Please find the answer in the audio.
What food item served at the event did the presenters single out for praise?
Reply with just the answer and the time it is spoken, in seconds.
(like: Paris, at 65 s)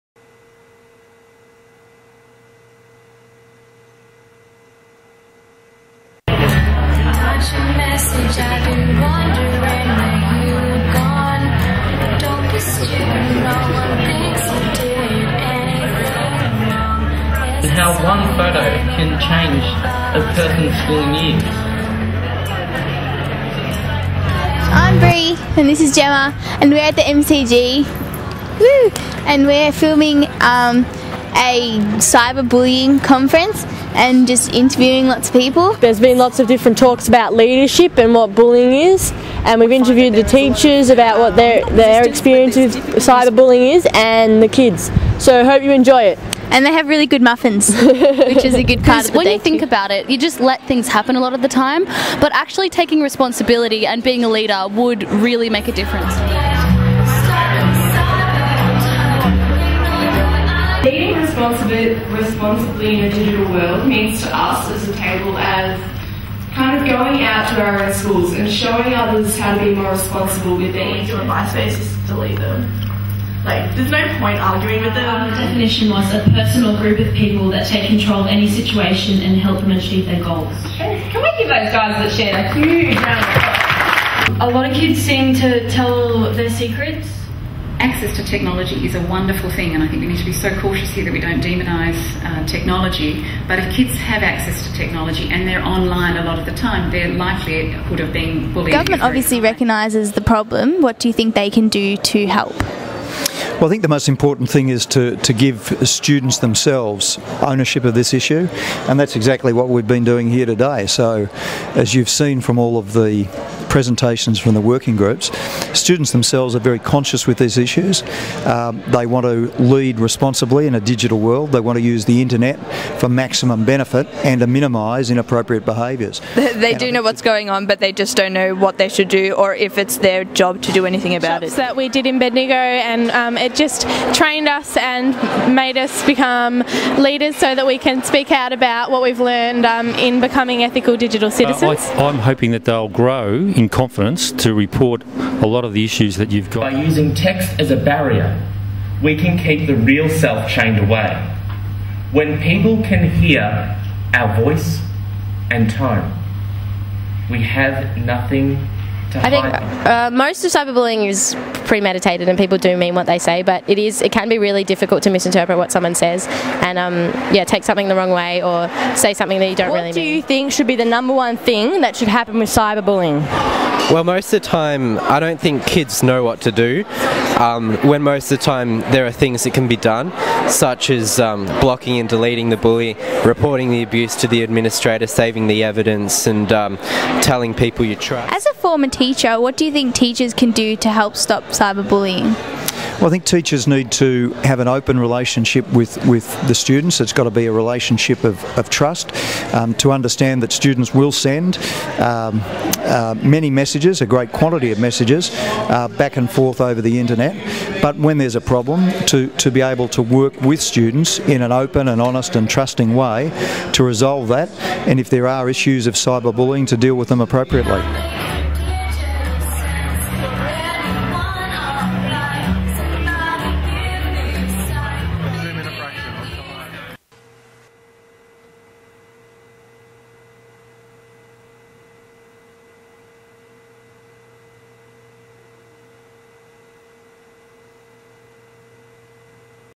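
Muffins, at 47 s.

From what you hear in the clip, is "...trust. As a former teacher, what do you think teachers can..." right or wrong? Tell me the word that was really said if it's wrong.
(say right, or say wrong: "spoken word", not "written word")
right.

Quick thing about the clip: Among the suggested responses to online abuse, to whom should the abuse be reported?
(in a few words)
The administrator.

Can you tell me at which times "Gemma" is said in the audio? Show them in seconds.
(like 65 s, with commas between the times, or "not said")
25 s.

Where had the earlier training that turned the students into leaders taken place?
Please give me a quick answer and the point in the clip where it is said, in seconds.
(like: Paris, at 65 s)
Bendigo, at 132 s.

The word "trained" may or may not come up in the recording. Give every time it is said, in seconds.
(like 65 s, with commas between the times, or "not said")
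134 s.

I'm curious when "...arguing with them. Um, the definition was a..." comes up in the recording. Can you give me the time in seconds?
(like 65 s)
74 s.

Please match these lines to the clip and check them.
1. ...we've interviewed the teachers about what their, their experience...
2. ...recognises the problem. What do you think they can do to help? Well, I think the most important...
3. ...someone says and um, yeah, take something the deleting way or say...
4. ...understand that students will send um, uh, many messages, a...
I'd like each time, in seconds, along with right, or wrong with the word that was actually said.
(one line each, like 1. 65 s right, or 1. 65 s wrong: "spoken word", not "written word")
1. 39 s right
2. 99 s right
3. 165 s wrong: "wrong", not "deleting"
4. 199 s right.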